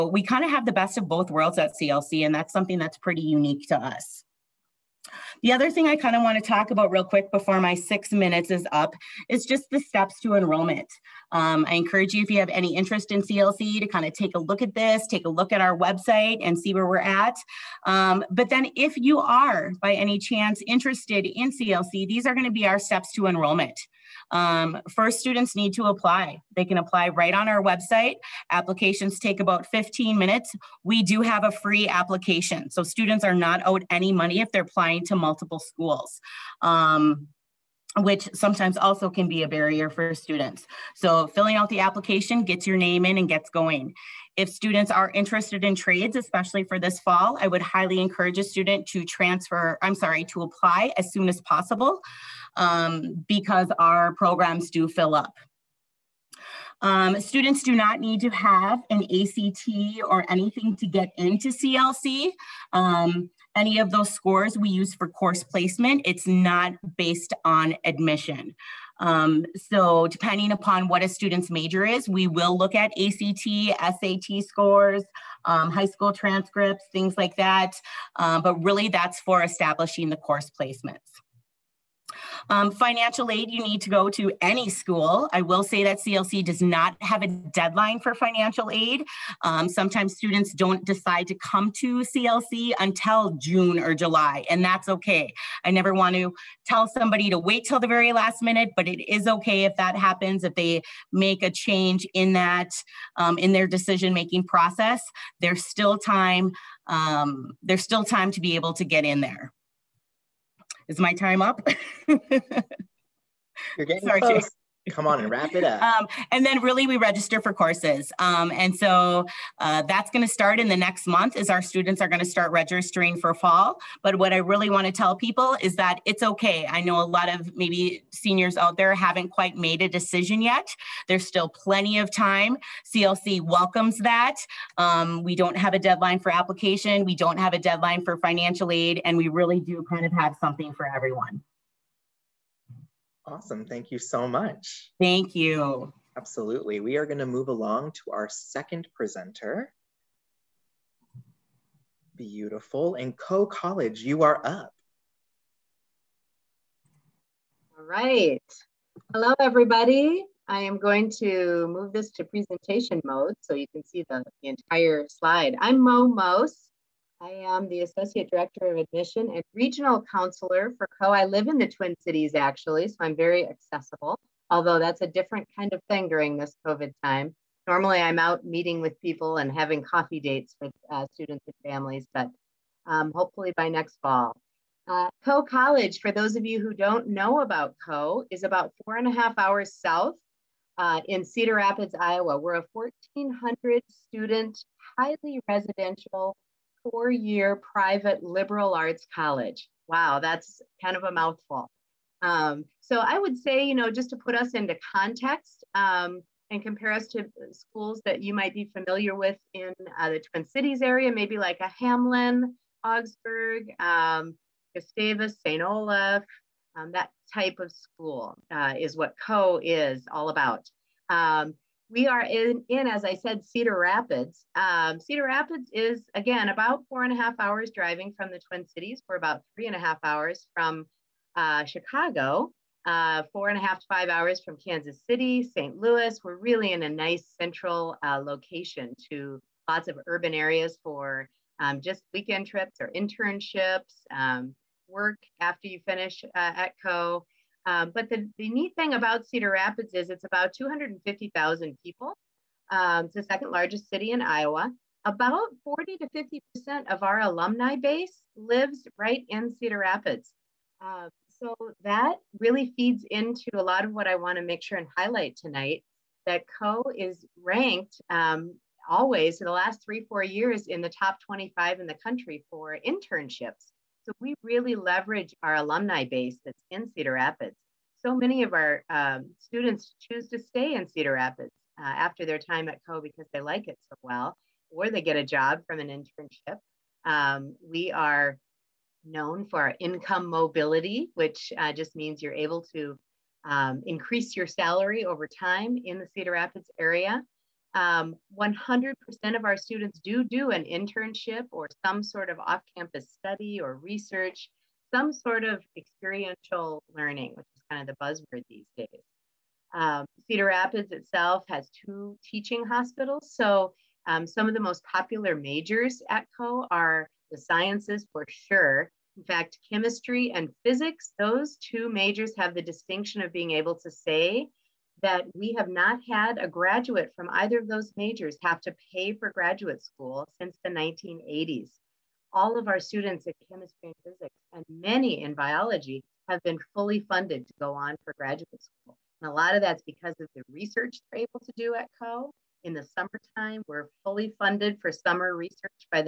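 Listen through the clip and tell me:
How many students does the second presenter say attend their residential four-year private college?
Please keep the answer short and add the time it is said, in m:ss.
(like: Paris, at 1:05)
1,400, at 3:12.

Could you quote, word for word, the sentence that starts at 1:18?
Um, but really that's for establishing the course placements.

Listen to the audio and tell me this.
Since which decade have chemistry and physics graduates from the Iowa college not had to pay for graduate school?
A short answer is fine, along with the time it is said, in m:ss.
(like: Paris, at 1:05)
1980s, at 5:30.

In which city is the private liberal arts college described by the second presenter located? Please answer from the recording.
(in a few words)
Cedar Rapids, Iowa.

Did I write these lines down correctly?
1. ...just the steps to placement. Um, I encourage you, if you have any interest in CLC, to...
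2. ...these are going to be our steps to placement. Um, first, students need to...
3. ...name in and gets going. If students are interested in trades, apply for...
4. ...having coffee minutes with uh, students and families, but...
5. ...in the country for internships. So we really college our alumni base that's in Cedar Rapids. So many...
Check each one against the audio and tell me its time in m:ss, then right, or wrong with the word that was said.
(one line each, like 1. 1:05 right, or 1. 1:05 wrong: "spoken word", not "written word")
1. 0:09 wrong: "enrollment", not "placement"
2. 0:22 wrong: "enrollment", not "placement"
3. 0:42 wrong: "especially", not "apply"
4. 2:59 wrong: "dates", not "minutes"
5. 4:31 wrong: "leverage", not "college".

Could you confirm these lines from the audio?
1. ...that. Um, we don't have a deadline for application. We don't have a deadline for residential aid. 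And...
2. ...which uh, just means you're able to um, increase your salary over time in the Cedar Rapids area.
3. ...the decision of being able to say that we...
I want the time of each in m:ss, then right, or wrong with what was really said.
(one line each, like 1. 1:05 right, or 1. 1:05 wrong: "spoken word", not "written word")
1. 2:13 wrong: "financial", not "residential"
2. 4:51 right
3. 5:22 wrong: "distinction", not "decision".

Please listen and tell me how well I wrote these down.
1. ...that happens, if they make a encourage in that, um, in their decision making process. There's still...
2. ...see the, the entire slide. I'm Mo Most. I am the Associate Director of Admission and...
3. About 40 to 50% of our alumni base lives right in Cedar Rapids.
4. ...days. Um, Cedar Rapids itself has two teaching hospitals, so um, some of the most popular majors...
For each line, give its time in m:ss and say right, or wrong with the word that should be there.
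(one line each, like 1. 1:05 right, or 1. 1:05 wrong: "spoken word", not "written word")
1. 1:39 wrong: "change", not "encourage"
2. 2:43 right
3. 4:15 right
4. 5:08 right.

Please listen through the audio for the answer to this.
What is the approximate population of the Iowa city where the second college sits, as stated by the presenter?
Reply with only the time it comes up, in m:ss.
4:10.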